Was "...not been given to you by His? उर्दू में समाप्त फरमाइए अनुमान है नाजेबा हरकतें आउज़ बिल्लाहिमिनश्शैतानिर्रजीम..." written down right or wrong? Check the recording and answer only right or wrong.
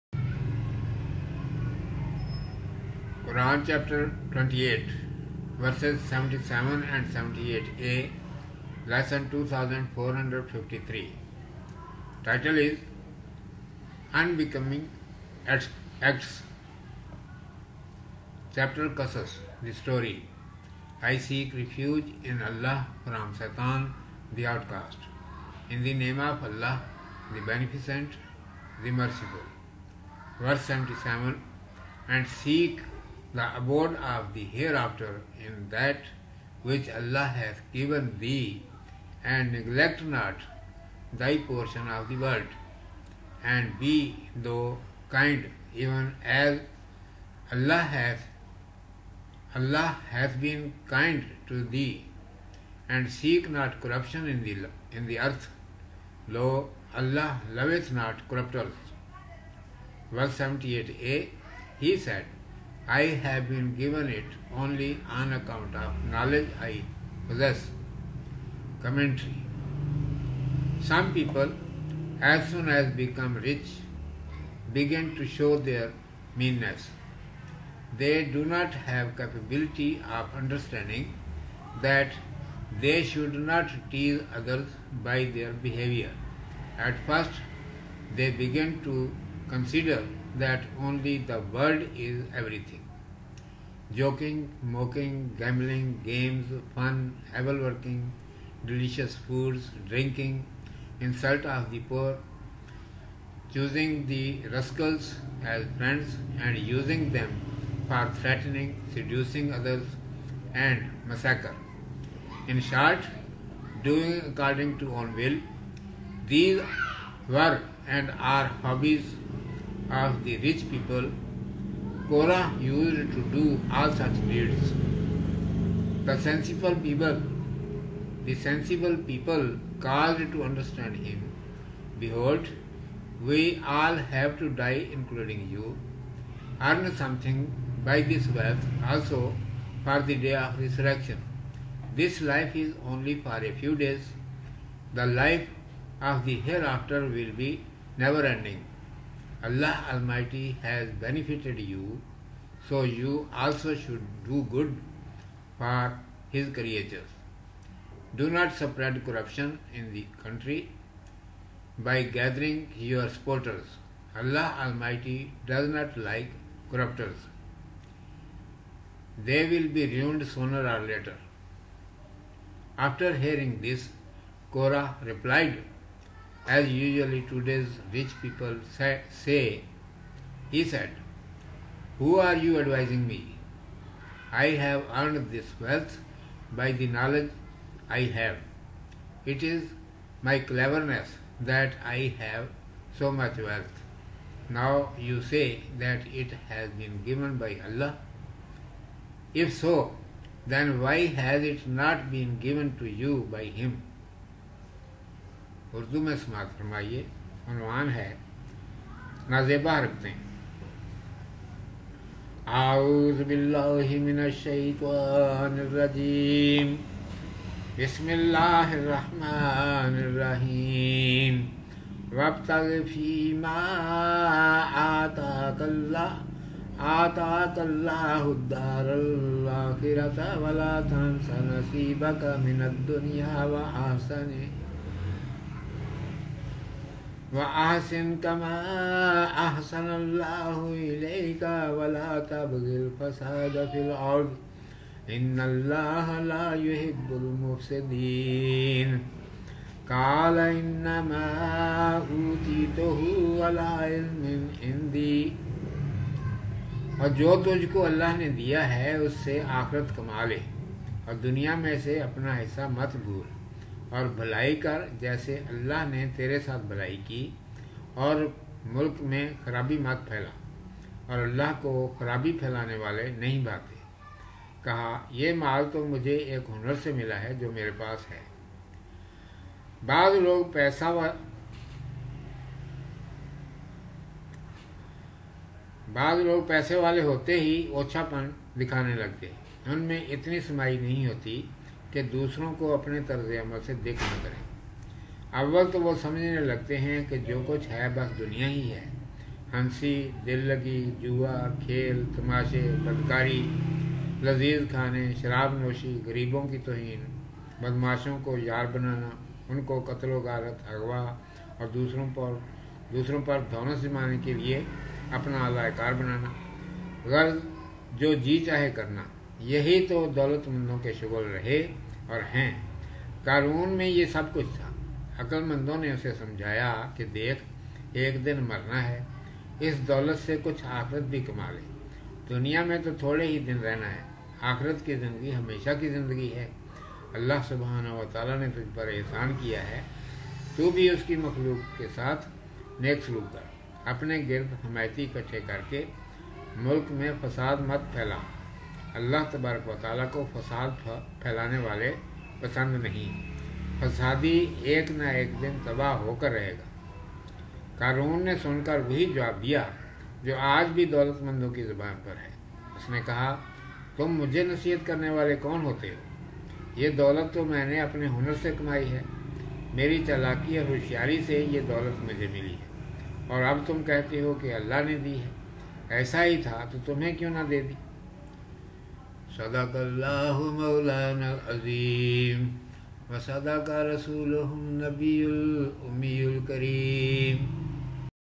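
wrong.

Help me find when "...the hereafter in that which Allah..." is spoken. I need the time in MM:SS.
00:34.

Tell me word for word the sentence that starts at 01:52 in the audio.
In short, doing according to own will.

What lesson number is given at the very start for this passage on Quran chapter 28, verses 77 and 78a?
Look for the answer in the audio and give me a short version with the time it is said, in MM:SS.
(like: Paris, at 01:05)
2453, at 00:08.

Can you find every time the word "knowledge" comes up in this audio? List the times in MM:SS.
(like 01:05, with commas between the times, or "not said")
01:06, 03:06.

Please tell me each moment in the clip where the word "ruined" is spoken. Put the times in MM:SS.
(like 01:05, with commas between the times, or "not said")
02:49.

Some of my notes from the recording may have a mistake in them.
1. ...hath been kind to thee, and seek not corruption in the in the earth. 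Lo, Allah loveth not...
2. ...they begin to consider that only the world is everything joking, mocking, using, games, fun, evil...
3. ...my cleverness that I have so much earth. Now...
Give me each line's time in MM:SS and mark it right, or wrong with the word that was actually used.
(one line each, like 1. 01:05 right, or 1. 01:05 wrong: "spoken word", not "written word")
1. 00:50 right
2. 01:28 wrong: "gambling", not "using"
3. 03:10 wrong: "wealth", not "earth".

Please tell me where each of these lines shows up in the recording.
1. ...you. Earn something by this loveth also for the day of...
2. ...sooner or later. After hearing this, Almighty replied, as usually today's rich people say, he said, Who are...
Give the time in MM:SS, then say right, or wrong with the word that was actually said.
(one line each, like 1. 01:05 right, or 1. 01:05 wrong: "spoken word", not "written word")
1. 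02:15 wrong: "wealth", not "loveth"
2. 02:50 wrong: "Korah", not "Almighty".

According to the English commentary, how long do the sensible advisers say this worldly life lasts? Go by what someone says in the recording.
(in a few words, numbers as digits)
a few days.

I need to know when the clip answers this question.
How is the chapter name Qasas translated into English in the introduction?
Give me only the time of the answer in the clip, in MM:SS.
00:19.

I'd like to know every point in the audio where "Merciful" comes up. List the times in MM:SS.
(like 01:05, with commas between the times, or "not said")
00:28.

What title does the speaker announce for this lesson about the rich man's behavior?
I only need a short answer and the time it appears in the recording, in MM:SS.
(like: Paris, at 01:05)
Unbecoming Acts, at 00:14.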